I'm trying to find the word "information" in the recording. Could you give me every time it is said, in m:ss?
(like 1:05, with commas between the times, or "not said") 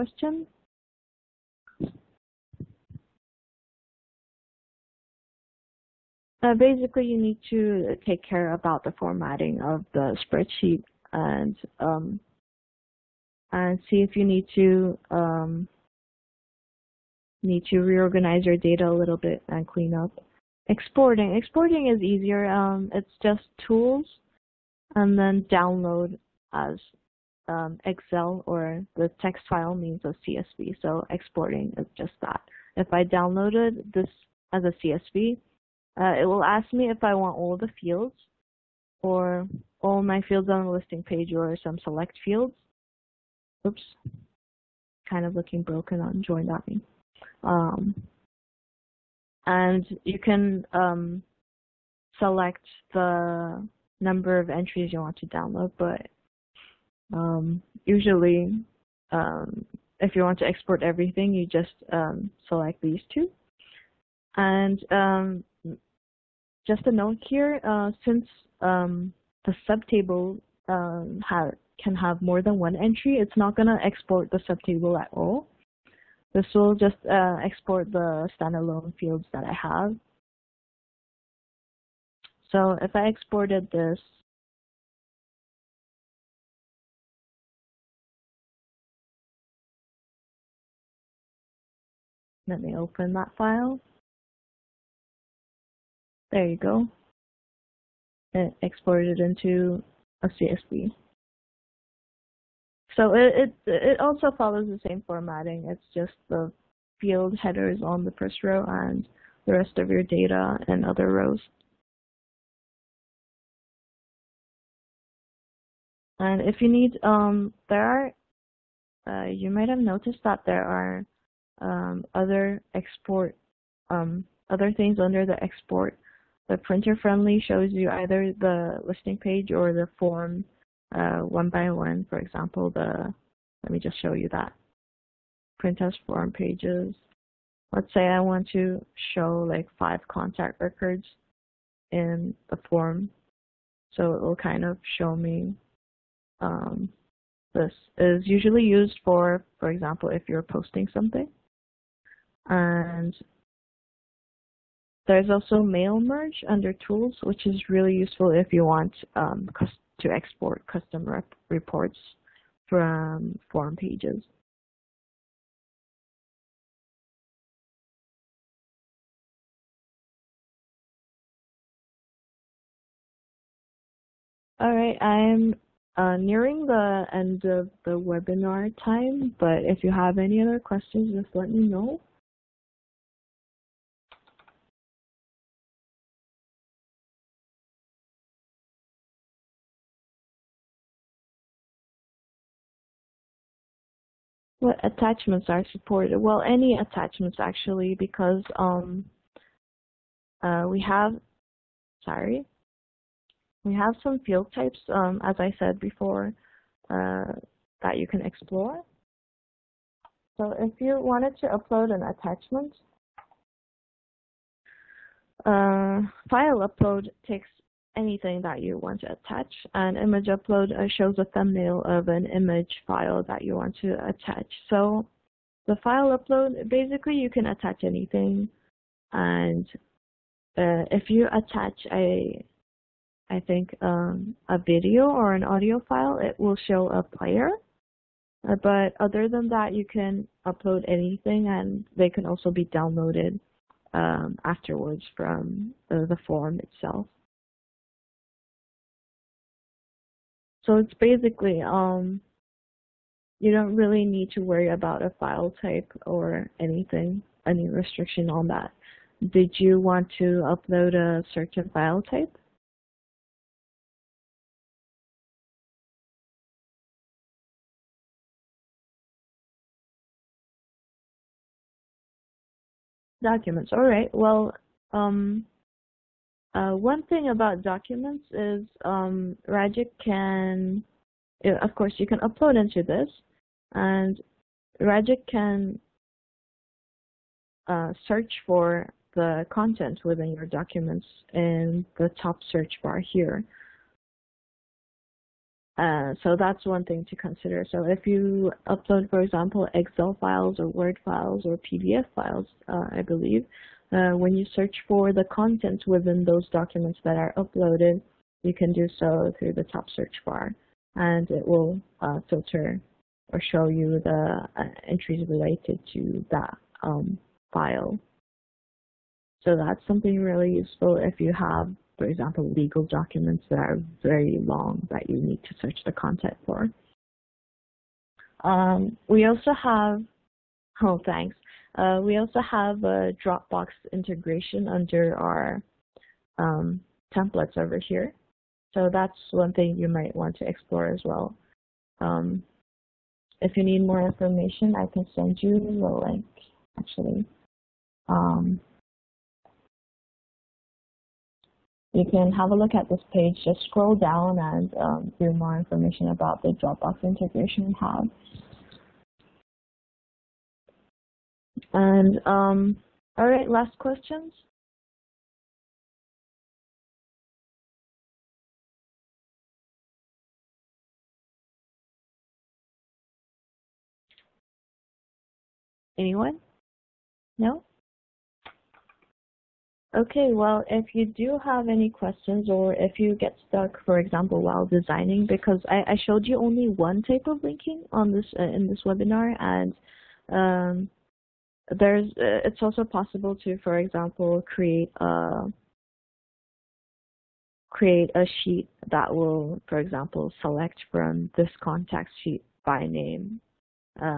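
5:44, 5:55.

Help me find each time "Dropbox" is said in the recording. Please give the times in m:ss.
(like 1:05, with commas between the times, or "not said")
5:33, 5:56.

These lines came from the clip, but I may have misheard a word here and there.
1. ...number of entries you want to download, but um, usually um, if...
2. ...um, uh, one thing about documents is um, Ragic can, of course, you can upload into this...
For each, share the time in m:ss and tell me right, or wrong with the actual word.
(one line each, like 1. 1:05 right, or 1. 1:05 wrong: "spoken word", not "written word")
1. 0:53 right
2. 4:34 right.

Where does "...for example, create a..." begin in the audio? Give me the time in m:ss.
6:33.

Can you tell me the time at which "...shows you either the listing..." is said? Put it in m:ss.
2:07.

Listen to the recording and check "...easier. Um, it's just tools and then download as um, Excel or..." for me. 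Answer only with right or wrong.
right.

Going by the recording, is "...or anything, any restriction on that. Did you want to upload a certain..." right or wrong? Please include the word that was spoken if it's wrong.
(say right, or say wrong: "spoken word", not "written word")
right.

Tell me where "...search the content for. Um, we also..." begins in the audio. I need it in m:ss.
5:25.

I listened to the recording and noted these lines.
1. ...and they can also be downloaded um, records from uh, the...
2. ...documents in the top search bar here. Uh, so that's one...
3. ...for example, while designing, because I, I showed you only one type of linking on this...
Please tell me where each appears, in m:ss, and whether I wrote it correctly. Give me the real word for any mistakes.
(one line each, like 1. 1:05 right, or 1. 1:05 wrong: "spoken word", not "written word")
1. 4:01 wrong: "afterwards", not "records"
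2. 4:50 right
3. 6:23 right.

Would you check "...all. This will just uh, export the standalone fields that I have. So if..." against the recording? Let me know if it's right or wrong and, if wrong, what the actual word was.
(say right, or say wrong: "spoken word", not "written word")
right.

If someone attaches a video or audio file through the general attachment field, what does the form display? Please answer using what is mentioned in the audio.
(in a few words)
A player.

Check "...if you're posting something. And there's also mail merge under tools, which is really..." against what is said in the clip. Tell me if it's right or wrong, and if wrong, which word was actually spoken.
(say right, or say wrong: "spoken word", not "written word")
right.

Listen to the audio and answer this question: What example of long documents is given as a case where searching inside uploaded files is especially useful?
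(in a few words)
Legal documents.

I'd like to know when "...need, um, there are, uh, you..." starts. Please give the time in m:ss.
1:56.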